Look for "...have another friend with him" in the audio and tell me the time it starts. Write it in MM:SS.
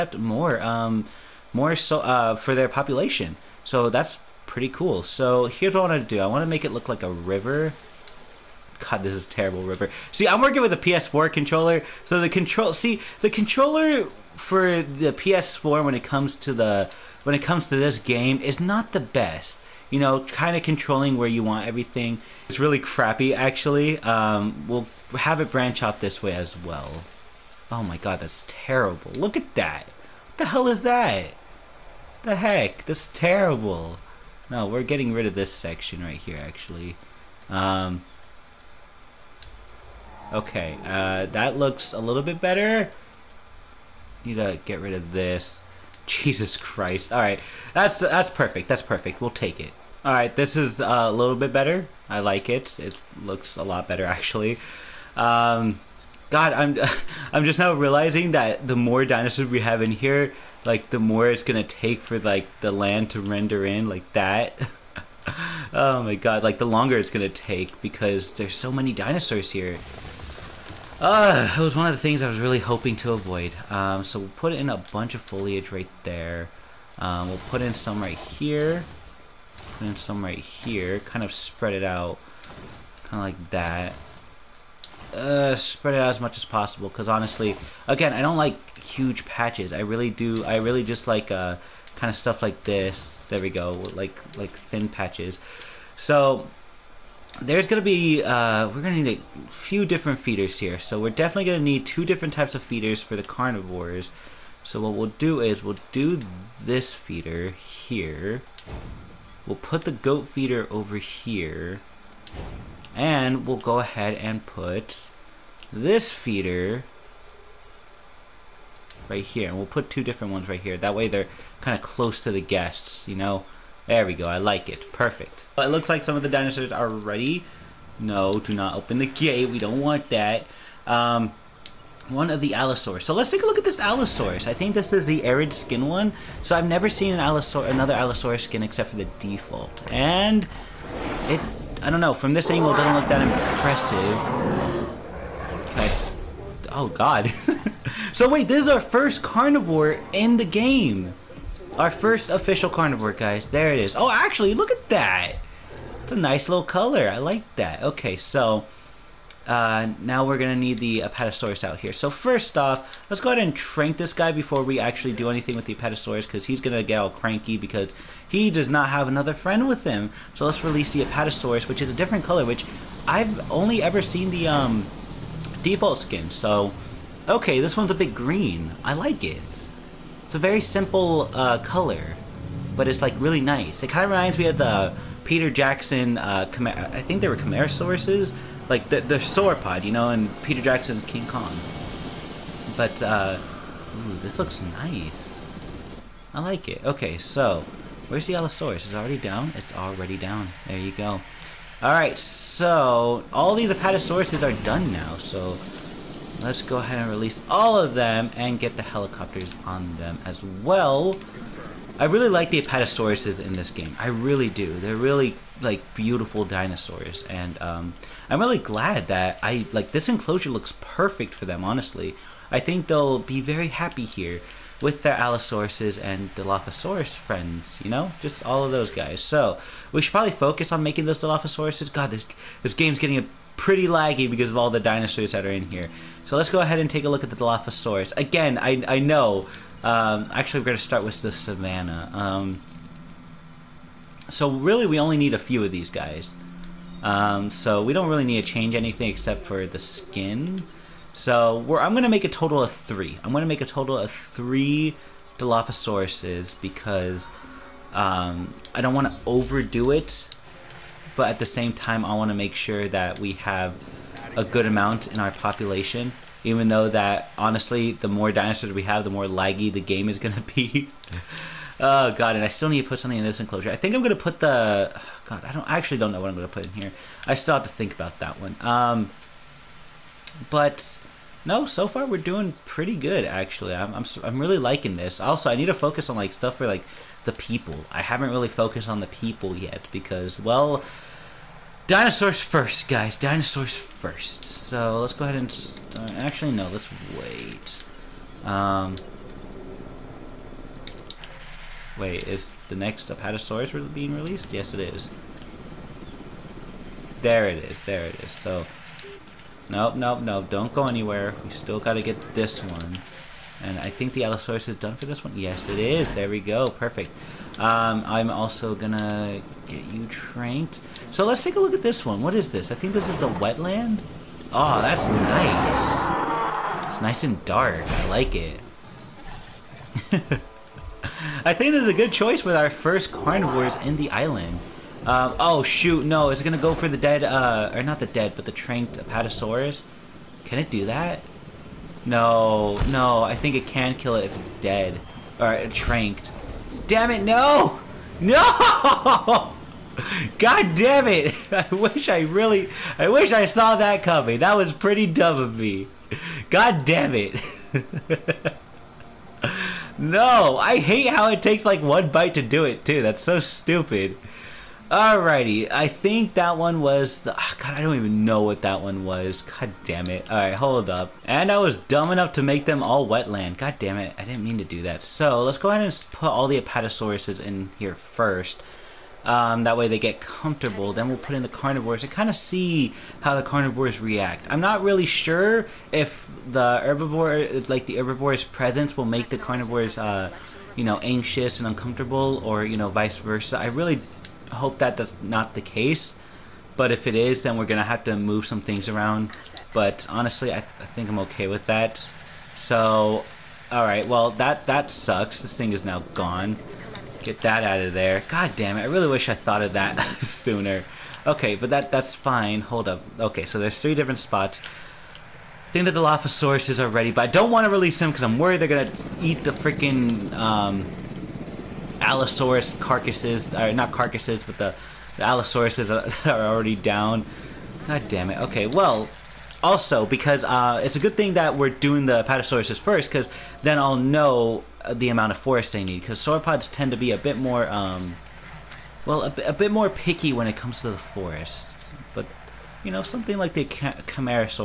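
02:48.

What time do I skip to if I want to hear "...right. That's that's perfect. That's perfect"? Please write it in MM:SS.
00:47.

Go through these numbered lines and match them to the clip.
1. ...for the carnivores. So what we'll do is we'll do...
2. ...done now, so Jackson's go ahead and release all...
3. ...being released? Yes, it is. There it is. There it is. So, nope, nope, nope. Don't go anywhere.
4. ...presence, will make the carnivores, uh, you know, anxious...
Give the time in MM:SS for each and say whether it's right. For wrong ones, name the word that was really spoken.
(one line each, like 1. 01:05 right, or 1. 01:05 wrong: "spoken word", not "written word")
1. 01:43 right
2. 03:24 wrong: "Let", not "Jackson"
3. 05:03 right
4. 06:28 right.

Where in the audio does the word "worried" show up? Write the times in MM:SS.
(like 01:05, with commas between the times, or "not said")
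06:58.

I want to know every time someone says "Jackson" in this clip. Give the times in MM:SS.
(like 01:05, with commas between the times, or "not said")
03:05, 03:10.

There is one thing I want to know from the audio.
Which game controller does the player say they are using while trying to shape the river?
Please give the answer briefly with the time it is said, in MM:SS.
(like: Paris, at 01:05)
PS4 controller, at 00:10.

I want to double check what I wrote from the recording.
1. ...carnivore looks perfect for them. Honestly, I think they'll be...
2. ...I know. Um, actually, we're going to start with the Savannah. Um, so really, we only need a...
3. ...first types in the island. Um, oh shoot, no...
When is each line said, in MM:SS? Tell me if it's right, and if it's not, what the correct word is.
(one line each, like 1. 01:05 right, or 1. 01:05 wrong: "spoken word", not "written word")
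1. 03:40 wrong: "enclosure", not "carnivore"
2. 03:58 right
3. 05:32 wrong: "carnivores", not "types".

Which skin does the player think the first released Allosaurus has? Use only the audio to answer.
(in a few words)
arid.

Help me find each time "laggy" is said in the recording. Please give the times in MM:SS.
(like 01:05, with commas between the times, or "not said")
03:53, 04:29.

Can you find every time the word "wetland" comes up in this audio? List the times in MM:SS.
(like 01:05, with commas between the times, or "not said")
05:23, 06:13.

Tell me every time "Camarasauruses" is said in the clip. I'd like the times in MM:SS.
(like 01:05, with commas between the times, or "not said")
03:07, 07:23.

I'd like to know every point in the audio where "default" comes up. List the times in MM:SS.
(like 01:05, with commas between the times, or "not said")
02:19, 02:55.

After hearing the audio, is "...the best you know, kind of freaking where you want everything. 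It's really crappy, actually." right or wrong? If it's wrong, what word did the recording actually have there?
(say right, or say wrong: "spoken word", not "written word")
wrong: "controlling", not "freaking".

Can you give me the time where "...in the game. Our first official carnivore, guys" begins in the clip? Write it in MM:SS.
02:30.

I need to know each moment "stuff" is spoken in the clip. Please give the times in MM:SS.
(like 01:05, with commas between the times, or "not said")
01:32, 04:46.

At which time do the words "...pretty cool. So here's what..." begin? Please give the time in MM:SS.
00:04.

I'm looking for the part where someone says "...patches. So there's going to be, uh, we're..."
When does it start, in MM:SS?
01:34.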